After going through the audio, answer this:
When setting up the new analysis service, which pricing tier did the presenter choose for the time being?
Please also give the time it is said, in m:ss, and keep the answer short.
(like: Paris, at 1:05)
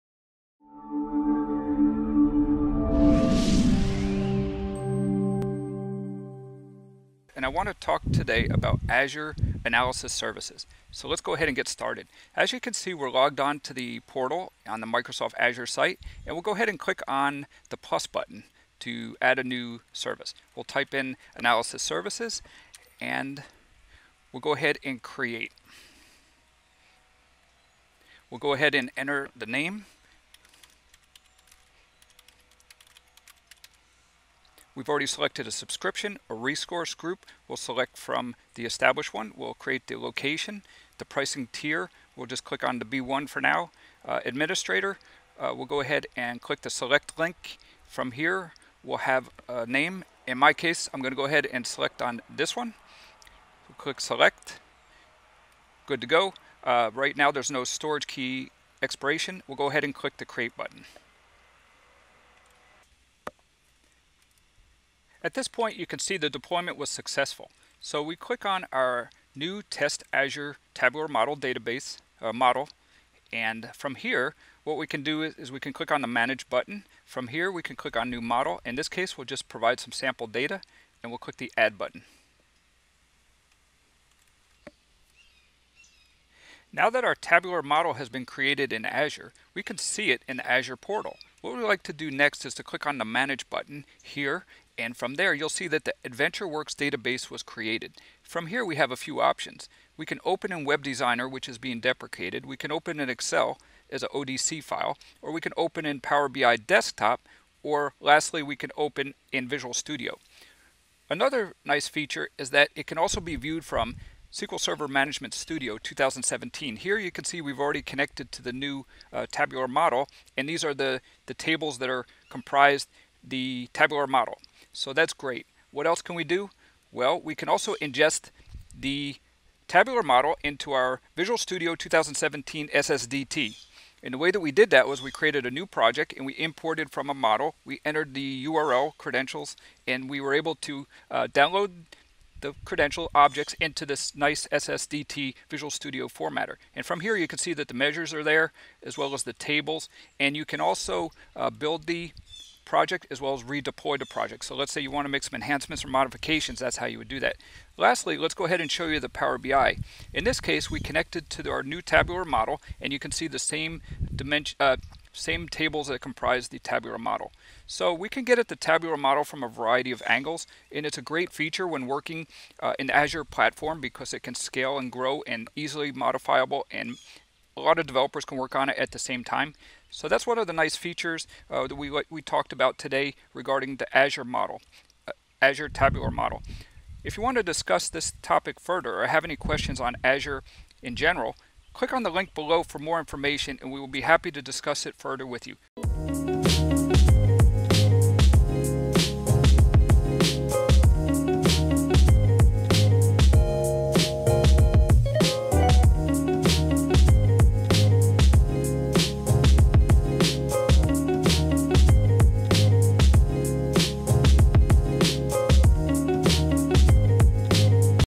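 B1, at 0:42.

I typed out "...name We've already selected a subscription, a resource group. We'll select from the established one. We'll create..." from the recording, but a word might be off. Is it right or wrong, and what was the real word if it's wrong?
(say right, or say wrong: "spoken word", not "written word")
right.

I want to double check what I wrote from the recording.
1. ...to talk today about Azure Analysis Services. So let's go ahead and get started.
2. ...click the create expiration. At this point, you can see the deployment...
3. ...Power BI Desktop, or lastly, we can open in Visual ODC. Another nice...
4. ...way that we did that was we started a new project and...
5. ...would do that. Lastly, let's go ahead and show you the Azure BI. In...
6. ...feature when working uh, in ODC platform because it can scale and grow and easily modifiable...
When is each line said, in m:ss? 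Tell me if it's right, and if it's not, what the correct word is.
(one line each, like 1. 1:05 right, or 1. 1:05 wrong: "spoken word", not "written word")
1. 0:07 right
2. 0:59 wrong: "button", not "expiration"
3. 1:45 wrong: "Studio", not "ODC"
4. 2:14 wrong: "created", not "started"
5. 2:36 wrong: "Power", not "Azure"
6. 2:51 wrong: "Azure", not "ODC".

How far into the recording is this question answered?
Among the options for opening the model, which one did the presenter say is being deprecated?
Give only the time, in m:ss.
1:40.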